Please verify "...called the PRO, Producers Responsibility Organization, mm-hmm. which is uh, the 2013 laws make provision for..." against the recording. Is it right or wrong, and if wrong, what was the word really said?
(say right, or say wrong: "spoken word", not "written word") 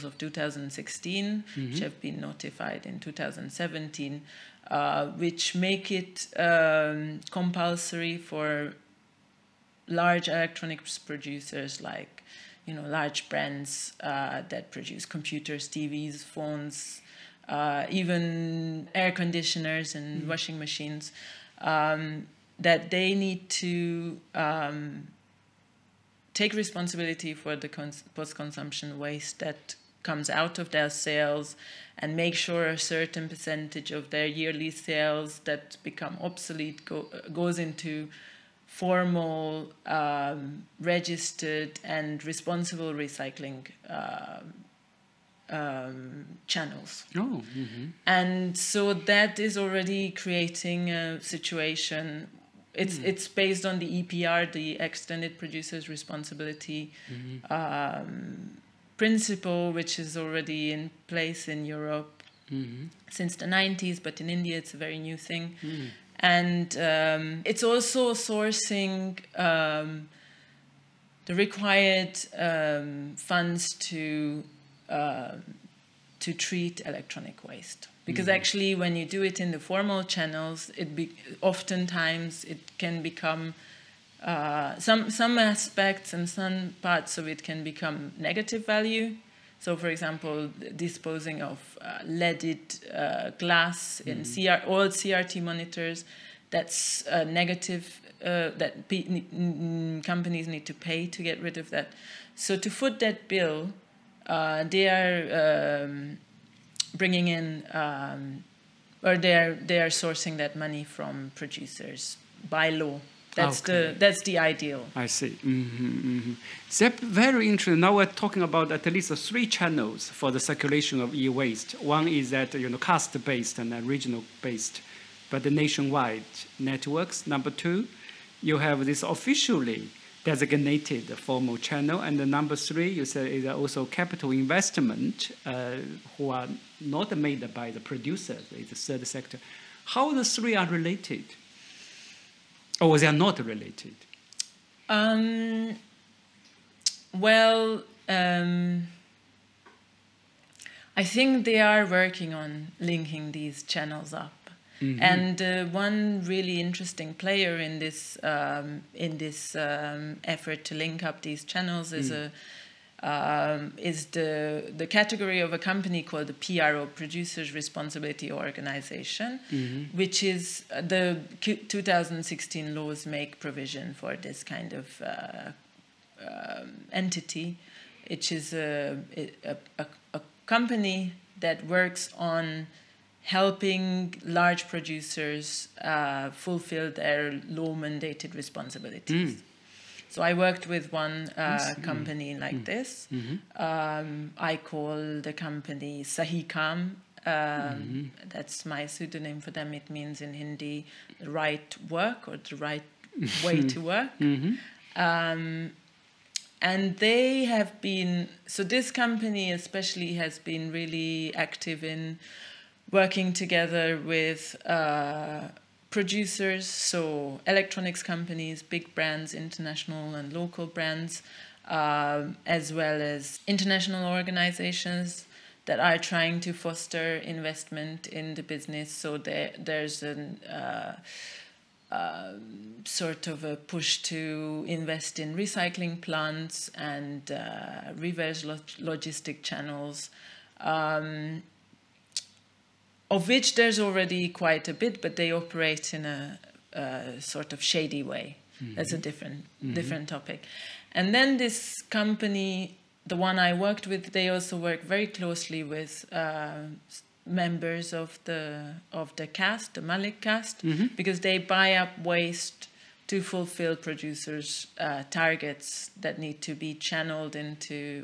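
wrong: "2016", not "2013".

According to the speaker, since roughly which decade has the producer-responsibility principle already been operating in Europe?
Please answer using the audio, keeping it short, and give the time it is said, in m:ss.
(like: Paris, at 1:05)
the 90s, at 1:03.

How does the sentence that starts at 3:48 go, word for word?
So there, there's a uh, uh, sort of a push to invest in recycling plants and uh, reverse log logistic channels.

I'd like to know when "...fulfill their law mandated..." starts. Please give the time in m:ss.
3:06.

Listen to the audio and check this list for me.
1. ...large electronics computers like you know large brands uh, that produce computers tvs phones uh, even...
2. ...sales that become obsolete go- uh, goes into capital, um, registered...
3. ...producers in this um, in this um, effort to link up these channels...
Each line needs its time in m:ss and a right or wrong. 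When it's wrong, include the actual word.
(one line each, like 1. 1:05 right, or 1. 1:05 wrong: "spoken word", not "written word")
1. 0:09 wrong: "producers", not "computers"
2. 0:34 wrong: "formal", not "capital"
3. 2:37 wrong: "player", not "producers".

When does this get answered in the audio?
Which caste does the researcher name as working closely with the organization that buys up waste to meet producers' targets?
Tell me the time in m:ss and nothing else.
4:19.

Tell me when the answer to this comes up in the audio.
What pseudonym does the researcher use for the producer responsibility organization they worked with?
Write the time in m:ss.
3:16.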